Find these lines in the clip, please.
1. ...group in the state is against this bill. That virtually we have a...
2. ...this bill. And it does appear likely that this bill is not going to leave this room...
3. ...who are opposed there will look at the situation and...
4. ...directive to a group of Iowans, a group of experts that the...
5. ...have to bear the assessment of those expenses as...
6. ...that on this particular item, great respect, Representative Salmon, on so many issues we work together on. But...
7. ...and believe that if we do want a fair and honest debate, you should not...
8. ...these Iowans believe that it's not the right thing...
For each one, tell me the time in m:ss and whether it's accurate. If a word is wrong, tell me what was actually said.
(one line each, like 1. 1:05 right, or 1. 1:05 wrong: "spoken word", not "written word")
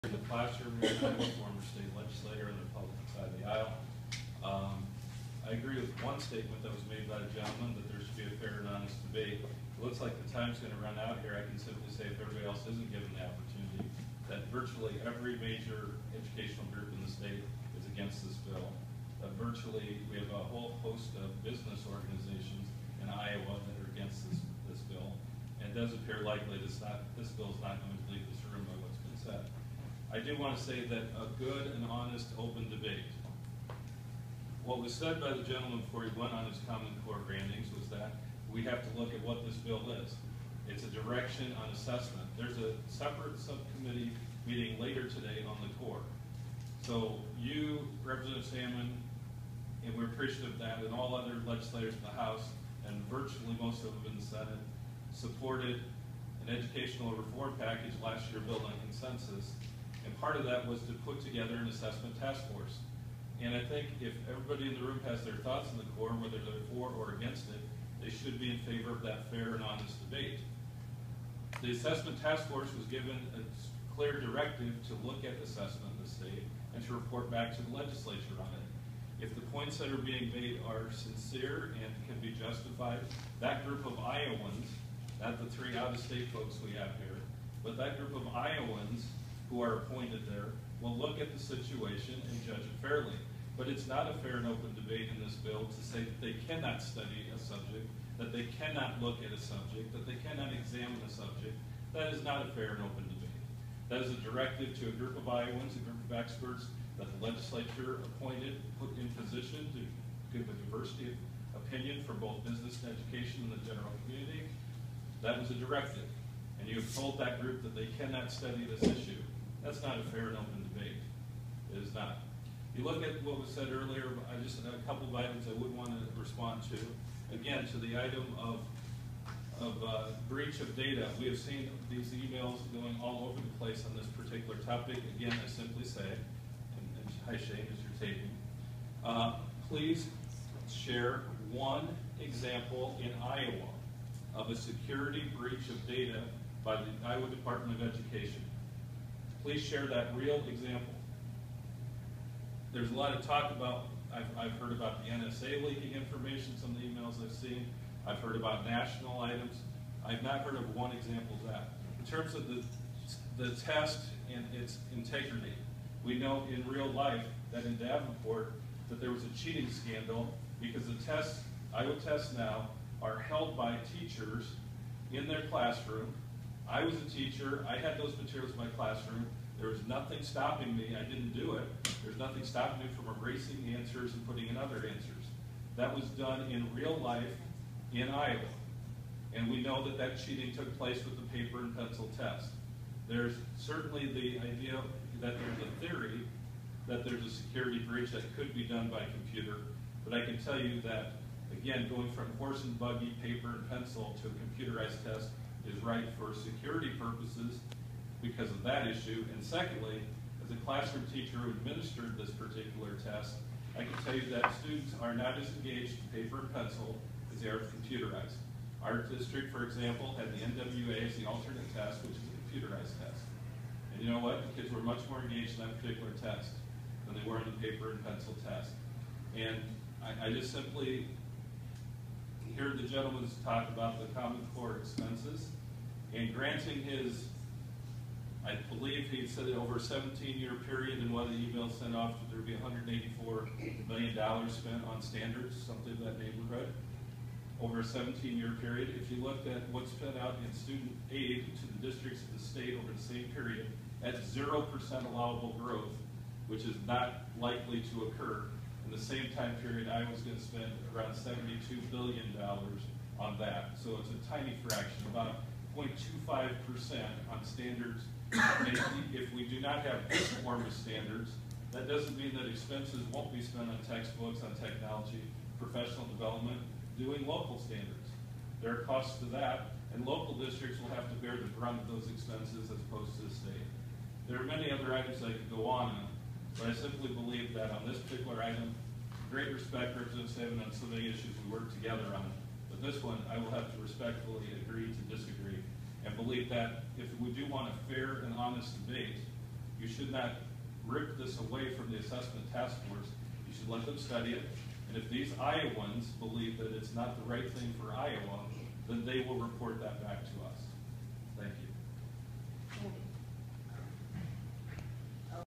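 1. 0:16 right
2. 0:24 right
3. 1:29 wrong: "appointed", not "opposed"
4. 1:44 right
5. 4:40 wrong: "brunt", not "assessment"
6. 4:47 right
7. 4:56 right
8. 5:05 right.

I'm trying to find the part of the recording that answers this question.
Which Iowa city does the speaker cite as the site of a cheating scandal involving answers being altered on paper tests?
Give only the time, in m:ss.
2:47.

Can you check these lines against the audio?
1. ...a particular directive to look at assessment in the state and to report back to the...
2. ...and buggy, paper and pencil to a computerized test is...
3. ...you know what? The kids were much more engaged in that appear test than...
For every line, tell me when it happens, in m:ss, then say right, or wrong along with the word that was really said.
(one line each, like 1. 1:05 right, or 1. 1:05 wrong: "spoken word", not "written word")
1. 1:13 wrong: "clear", not "particular"
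2. 3:22 right
3. 3:44 wrong: "particular", not "appear".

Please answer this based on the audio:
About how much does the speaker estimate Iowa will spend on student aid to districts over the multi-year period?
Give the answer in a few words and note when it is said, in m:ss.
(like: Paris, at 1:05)
$72 billion, at 4:21.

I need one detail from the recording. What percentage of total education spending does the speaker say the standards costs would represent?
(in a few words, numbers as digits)
0.25%.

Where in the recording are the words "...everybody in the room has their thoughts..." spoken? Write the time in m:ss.
1:04.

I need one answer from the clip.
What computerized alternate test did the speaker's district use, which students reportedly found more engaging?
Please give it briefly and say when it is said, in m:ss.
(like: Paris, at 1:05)
NWA, at 3:40.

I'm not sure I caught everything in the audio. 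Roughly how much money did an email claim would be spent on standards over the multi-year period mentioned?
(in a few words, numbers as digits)
$184 million.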